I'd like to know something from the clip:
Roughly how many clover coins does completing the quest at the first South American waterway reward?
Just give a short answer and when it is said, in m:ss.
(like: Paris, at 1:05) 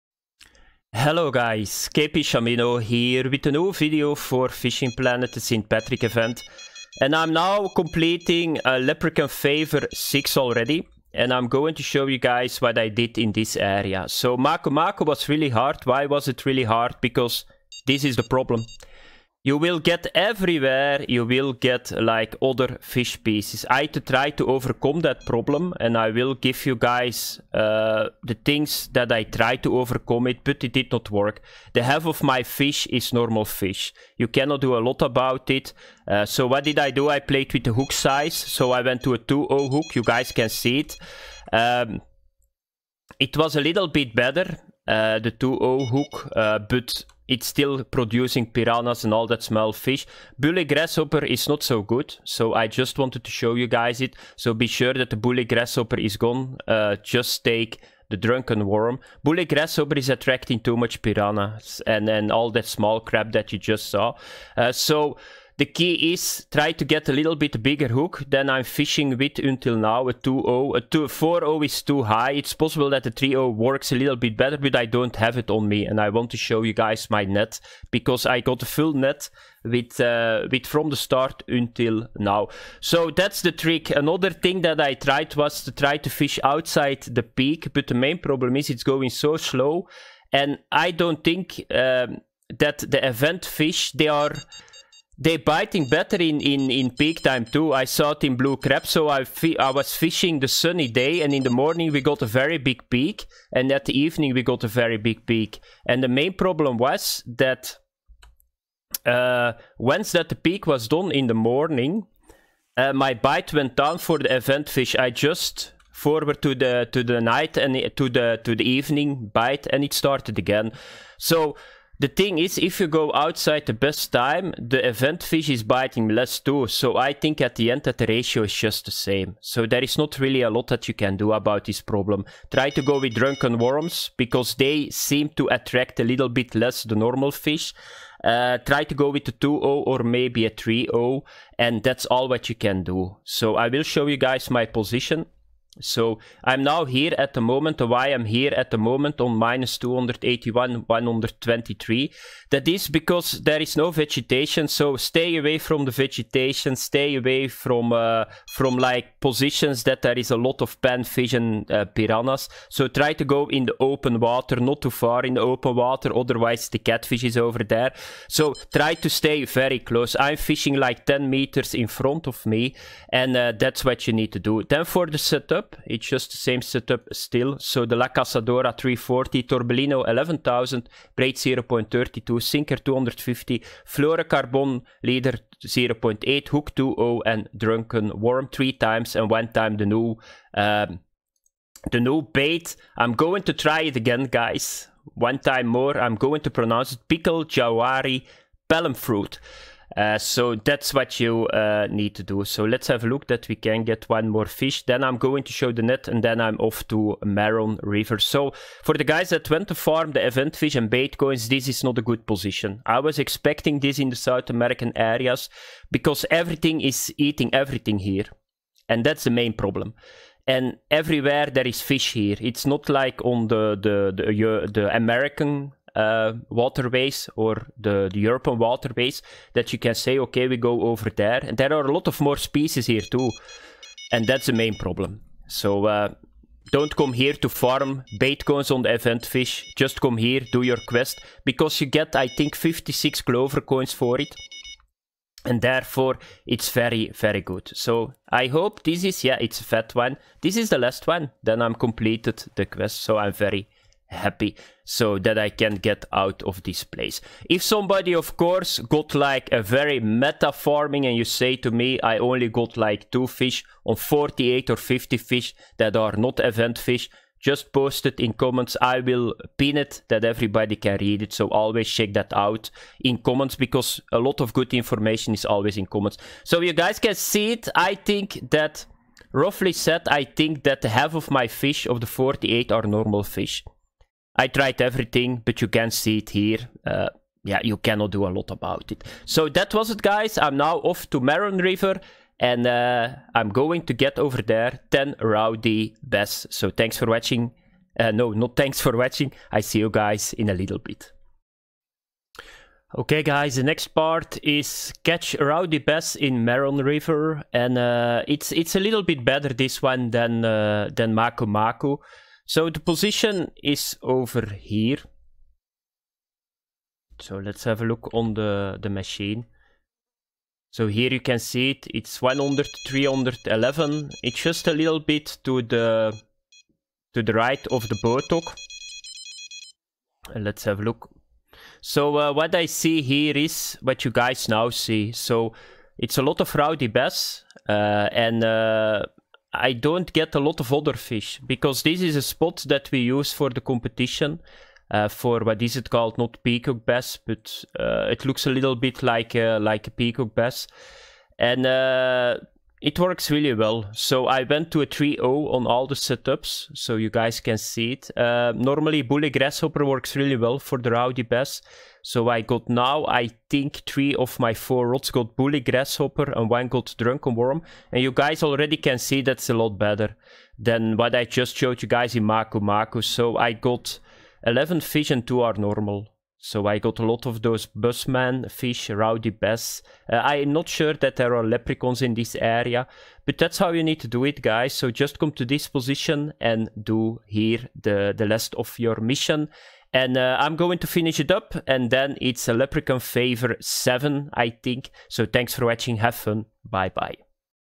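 56, at 4:02.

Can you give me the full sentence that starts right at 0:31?
The half of my fish is normal fish.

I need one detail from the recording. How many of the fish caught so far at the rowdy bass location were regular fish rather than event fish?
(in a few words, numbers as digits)
2.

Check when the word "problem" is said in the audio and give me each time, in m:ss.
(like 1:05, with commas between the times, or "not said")
0:18, 0:25, 1:28, 1:46, 2:11, 3:39, 3:54.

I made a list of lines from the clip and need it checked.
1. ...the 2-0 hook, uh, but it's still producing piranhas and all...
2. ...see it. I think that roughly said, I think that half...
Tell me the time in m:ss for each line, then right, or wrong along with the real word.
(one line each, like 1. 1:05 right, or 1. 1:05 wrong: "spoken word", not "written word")
1. 0:45 right
2. 4:37 right.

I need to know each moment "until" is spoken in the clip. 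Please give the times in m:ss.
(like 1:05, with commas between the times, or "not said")
1:09, 1:21.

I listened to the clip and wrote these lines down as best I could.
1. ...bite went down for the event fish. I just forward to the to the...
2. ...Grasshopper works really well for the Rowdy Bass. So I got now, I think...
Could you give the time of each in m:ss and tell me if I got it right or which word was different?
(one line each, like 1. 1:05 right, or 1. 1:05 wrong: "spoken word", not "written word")
1. 1:53 right
2. 5:59 right.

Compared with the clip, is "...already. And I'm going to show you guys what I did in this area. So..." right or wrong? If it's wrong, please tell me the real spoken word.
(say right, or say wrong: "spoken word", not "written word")
right.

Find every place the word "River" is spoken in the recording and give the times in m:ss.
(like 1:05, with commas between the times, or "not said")
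3:27, 4:51, 5:06.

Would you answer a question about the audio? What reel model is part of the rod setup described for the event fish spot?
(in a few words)
Torbellino 11,000.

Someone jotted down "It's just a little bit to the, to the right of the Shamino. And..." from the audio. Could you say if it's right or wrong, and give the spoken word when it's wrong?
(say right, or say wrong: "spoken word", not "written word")
wrong: "Botok", not "Shamino".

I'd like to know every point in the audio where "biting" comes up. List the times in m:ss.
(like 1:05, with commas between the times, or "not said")
1:35, 2:05.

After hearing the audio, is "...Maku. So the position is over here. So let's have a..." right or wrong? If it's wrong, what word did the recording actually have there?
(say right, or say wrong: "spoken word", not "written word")
right.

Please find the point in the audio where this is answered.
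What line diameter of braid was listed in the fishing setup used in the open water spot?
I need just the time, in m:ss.
3:01.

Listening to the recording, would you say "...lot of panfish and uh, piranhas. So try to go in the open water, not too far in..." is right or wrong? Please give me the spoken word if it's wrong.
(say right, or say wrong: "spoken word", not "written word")
right.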